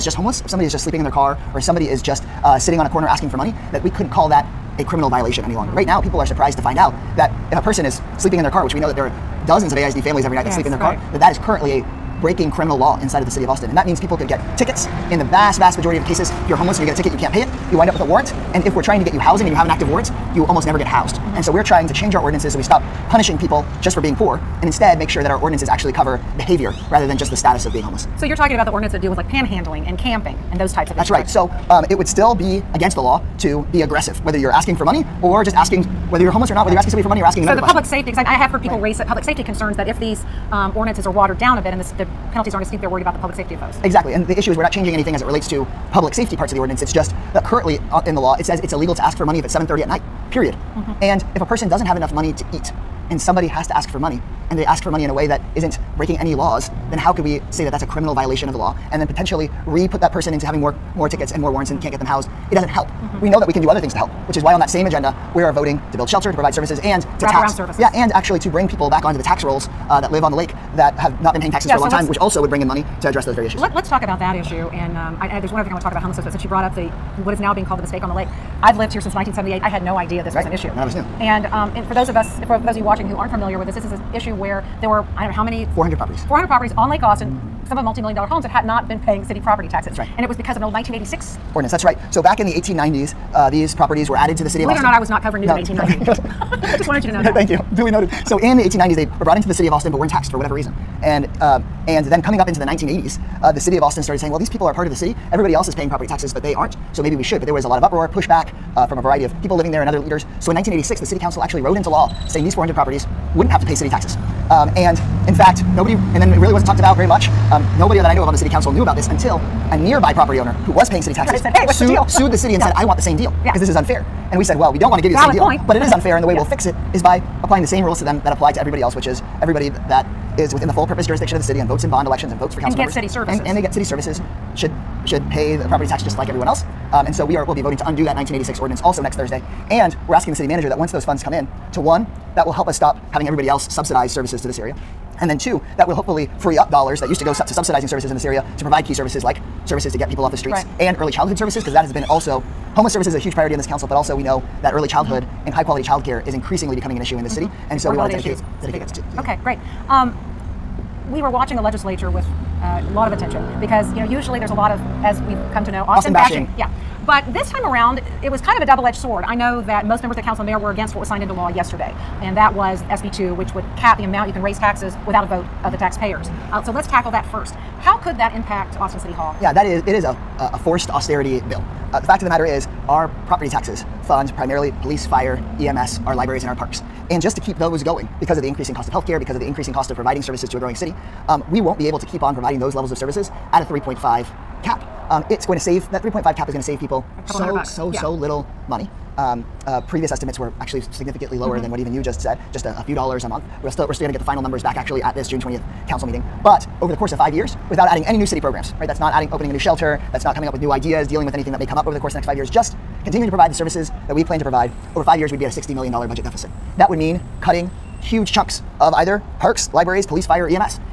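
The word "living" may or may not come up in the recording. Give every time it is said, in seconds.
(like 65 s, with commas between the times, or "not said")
109 s.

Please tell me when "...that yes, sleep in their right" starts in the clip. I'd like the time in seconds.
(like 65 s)
10 s.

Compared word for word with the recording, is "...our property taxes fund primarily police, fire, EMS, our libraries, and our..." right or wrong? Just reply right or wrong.
right.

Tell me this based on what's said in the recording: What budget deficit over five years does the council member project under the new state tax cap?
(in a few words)
$60 million.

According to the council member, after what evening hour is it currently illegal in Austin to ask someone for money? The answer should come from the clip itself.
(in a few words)
7:30.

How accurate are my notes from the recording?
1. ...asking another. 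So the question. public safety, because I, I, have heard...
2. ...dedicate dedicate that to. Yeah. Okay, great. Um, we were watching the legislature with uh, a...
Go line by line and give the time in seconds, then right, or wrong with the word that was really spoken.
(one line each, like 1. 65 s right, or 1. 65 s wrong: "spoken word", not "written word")
1. 37 s right
2. 158 s right.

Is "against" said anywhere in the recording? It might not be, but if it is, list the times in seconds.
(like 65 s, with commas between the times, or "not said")
32 s, 170 s.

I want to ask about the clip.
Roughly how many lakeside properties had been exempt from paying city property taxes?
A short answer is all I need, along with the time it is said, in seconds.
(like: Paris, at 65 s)
400, at 86 s.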